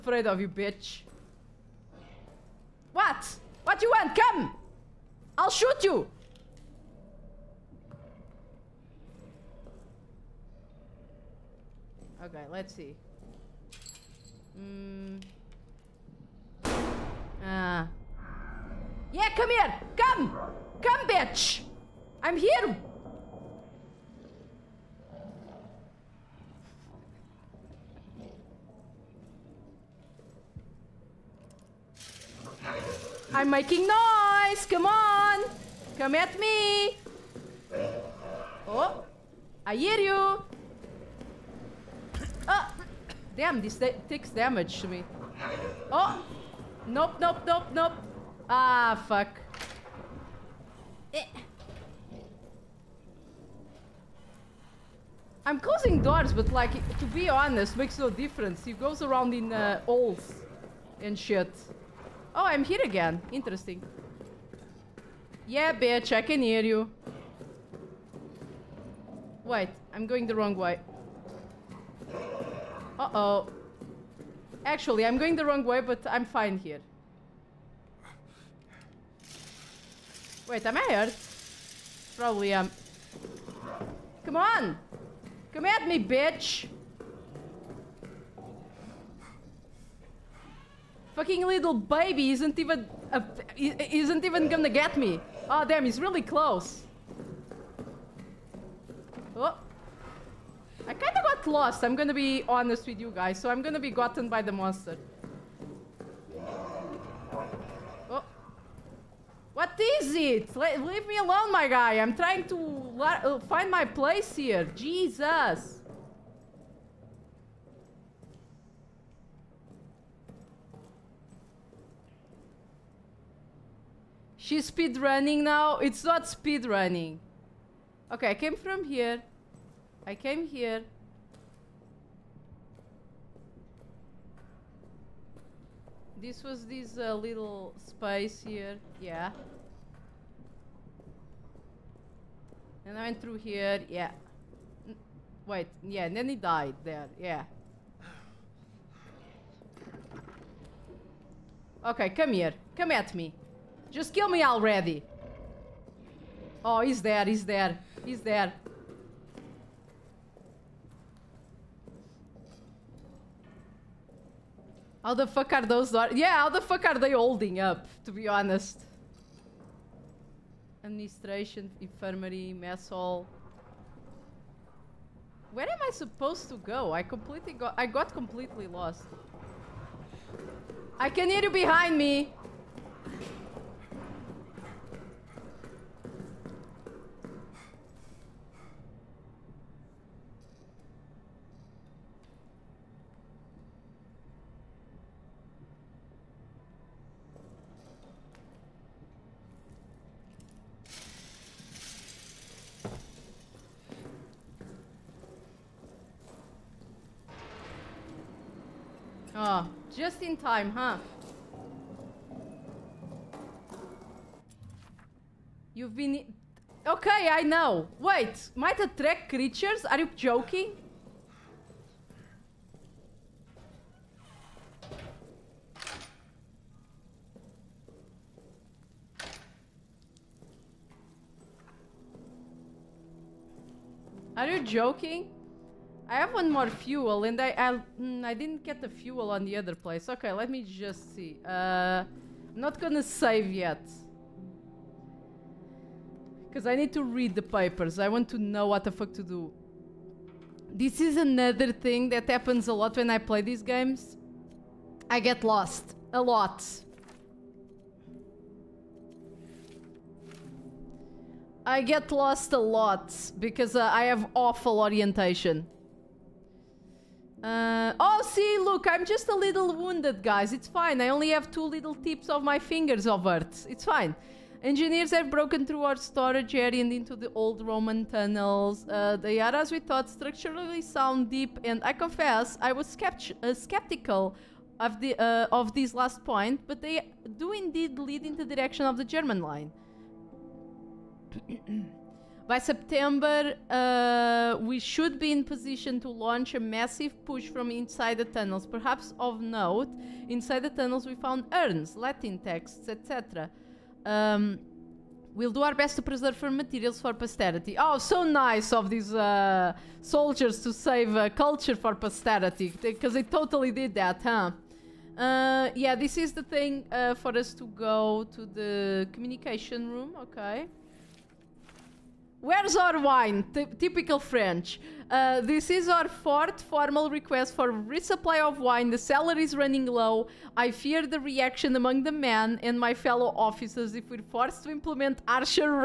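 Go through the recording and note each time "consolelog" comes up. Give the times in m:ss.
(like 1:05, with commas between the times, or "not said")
not said.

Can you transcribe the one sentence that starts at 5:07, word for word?
Oh, so nice of these uh, soldiers to save uh, culture for posterity, because they totally did that, huh?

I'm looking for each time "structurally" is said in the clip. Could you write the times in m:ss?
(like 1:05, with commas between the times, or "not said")
4:40.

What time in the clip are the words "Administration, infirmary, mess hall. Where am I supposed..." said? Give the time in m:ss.
2:50.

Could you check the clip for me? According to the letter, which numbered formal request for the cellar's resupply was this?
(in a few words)
fourth.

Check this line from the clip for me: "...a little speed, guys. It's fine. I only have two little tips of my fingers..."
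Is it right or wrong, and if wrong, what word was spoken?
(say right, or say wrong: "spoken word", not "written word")
wrong: "wounded", not "speed".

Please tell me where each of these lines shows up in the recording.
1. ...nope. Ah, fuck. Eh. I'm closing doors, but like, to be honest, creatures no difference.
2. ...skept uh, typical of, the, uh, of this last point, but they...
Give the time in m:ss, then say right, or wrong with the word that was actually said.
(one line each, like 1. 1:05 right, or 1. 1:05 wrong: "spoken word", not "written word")
1. 0:47 wrong: "makes", not "creatures"
2. 4:42 wrong: "skeptical", not "typical".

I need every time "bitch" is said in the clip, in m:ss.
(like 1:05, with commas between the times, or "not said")
0:00, 0:21, 1:05, 1:26.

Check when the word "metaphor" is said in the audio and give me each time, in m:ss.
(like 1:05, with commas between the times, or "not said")
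not said.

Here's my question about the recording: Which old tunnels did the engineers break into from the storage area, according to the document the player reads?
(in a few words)
Roman tunnels.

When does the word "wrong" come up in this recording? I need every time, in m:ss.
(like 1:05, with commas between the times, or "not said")
1:10, 1:15.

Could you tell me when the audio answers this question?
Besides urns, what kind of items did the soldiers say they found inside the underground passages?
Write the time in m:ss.
5:01.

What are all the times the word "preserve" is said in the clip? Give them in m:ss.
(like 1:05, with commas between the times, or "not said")
5:06.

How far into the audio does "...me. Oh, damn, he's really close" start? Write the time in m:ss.
1:34.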